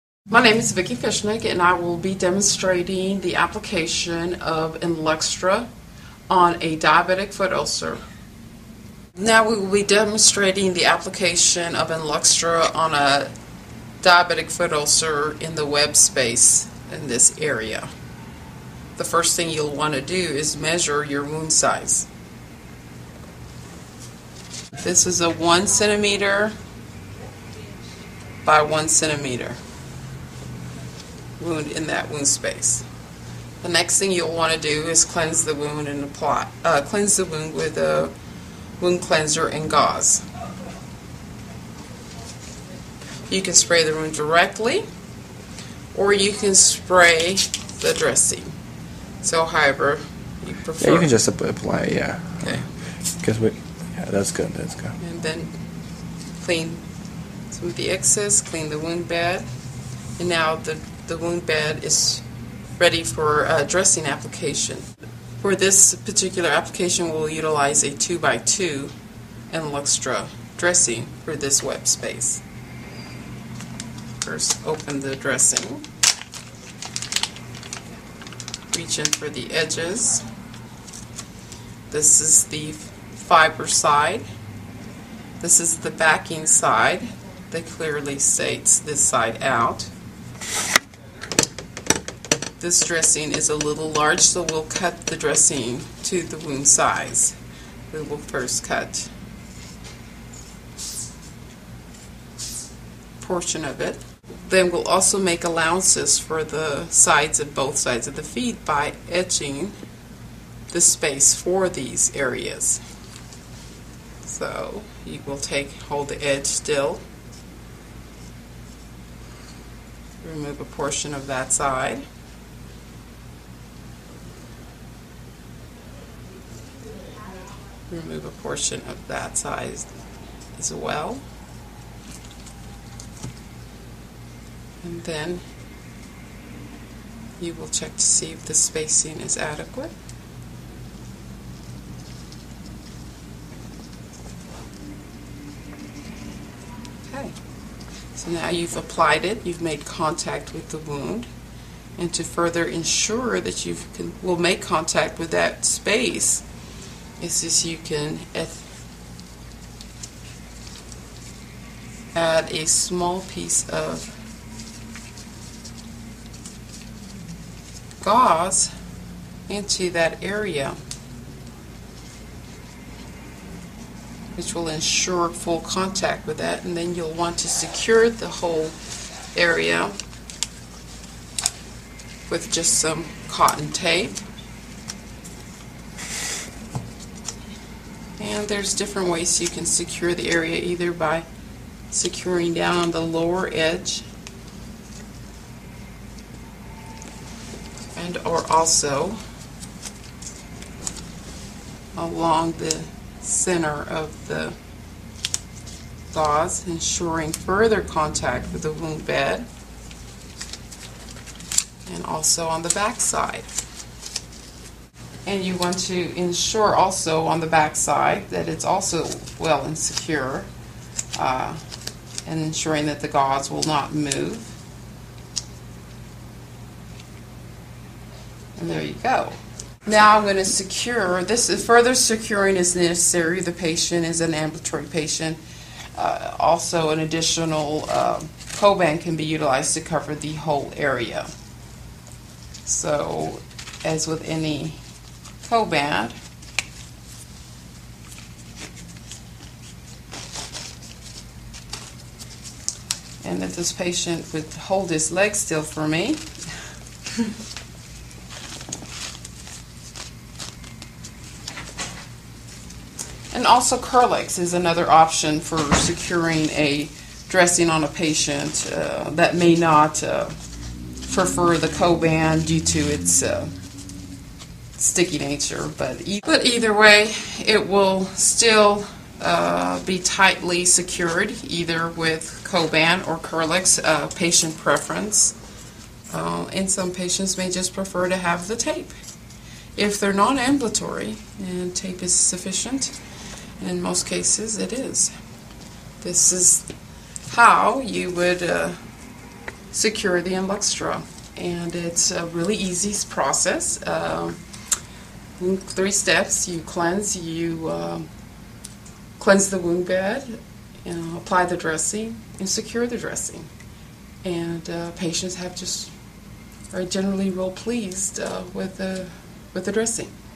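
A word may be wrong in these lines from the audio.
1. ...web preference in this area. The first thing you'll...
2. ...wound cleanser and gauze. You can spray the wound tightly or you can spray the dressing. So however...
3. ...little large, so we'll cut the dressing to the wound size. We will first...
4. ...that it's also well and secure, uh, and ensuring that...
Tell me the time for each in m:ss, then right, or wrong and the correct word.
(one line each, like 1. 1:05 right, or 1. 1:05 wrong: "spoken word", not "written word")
1. 0:15 wrong: "space", not "preference"
2. 0:38 wrong: "directly", not "tightly"
3. 1:33 right
4. 3:38 right.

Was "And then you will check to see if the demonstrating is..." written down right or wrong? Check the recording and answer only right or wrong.
wrong.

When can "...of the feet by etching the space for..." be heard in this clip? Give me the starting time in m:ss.
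1:48.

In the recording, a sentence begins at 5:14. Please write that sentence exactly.
And uh, patients have just are generally real pleased uh, with the with the dressing.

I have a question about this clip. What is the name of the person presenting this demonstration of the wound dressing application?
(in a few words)
Vicki Fishnick.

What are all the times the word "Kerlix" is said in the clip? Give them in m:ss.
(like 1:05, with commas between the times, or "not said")
4:23, 4:43.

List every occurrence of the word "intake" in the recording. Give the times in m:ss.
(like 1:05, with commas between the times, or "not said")
not said.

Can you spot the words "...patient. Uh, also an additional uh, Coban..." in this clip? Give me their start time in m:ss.
3:54.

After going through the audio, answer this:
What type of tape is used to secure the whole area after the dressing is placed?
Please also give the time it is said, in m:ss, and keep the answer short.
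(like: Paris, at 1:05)
cotton tape, at 3:03.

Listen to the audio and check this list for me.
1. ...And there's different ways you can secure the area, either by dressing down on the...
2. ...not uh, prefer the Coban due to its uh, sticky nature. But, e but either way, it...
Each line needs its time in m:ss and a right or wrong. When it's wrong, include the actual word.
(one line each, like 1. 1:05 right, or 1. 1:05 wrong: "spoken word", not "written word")
1. 3:08 wrong: "securing", not "dressing"
2. 4:29 right.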